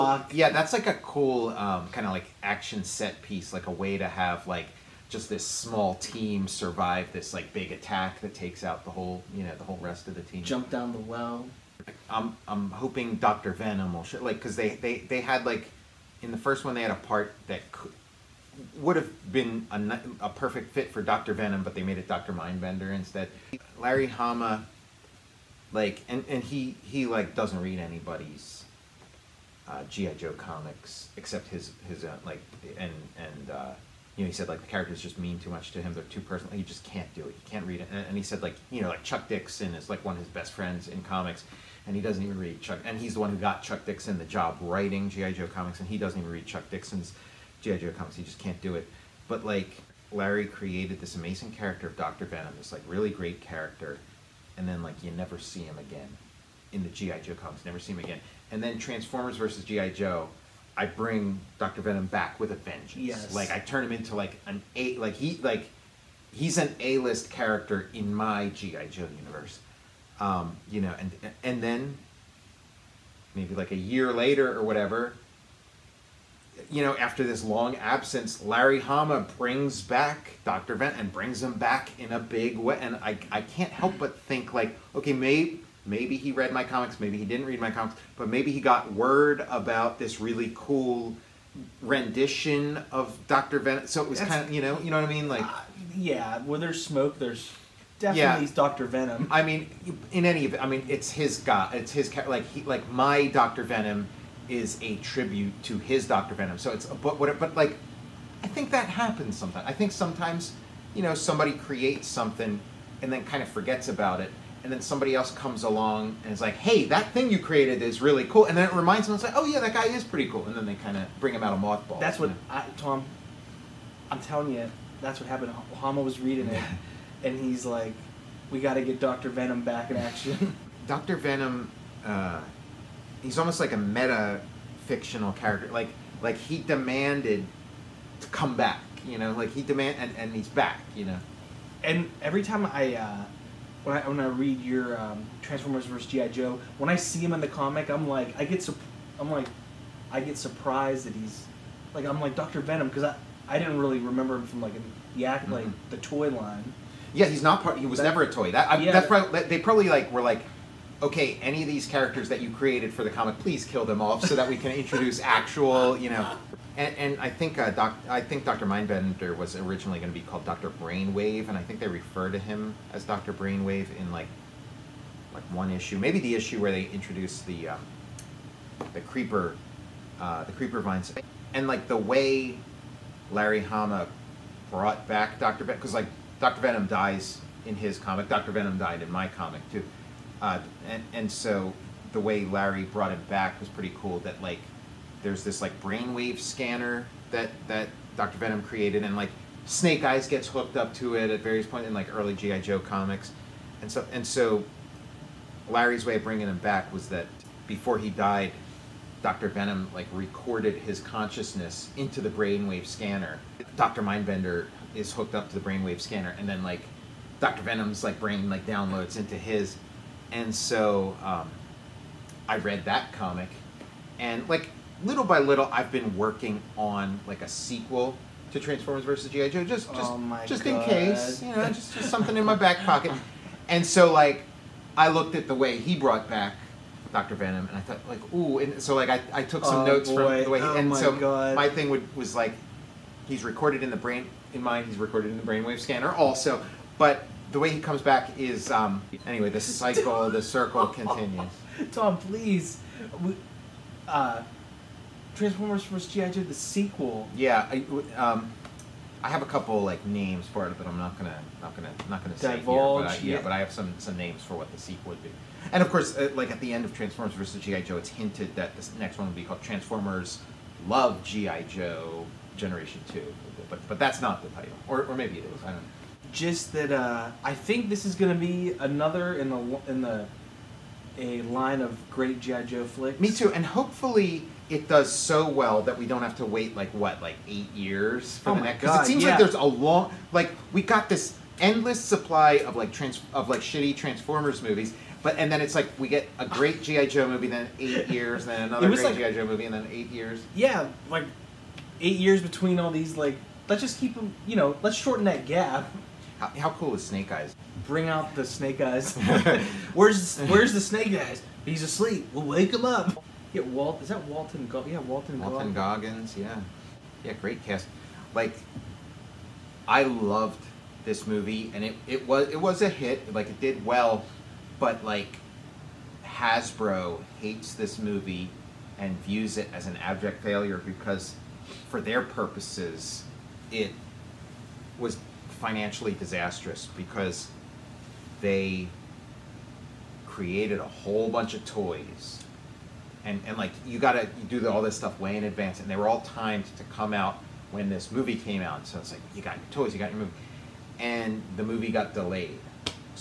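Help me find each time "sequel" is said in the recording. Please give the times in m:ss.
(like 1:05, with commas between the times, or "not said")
3:47, 4:16, 4:24.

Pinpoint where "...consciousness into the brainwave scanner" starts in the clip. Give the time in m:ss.
3:30.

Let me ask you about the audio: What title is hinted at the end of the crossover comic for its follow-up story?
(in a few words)
Transformers Love G.I. Joe Generation Two.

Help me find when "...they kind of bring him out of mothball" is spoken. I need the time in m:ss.
2:00.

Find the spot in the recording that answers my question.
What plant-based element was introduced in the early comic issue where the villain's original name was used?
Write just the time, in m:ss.
3:00.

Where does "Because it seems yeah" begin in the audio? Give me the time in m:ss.
4:48.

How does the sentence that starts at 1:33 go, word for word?
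So it was kind of you know you know what I mean like uh, yeah, where there's smoke, there's definitely yeah.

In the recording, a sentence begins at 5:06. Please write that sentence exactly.
How, how cool is Snake Eyes?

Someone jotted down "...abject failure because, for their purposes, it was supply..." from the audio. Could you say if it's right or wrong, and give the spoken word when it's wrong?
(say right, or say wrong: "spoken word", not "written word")
wrong: "financially", not "supply".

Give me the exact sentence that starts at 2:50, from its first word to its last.
Brainwave, and I think they refer to him as Dr.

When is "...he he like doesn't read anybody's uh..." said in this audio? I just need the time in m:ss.
0:26.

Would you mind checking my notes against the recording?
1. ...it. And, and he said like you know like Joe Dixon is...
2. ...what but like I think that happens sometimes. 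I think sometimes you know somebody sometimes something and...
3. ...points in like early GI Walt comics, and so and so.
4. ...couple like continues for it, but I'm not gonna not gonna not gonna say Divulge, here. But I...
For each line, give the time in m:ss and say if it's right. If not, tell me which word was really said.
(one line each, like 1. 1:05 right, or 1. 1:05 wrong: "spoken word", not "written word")
1. 0:37 wrong: "Chuck", not "Joe"
2. 1:47 wrong: "creates", not "sometimes"
3. 3:21 wrong: "Joe", not "Walt"
4. 4:19 wrong: "names", not "continues".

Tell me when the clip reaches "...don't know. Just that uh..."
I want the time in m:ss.
4:35.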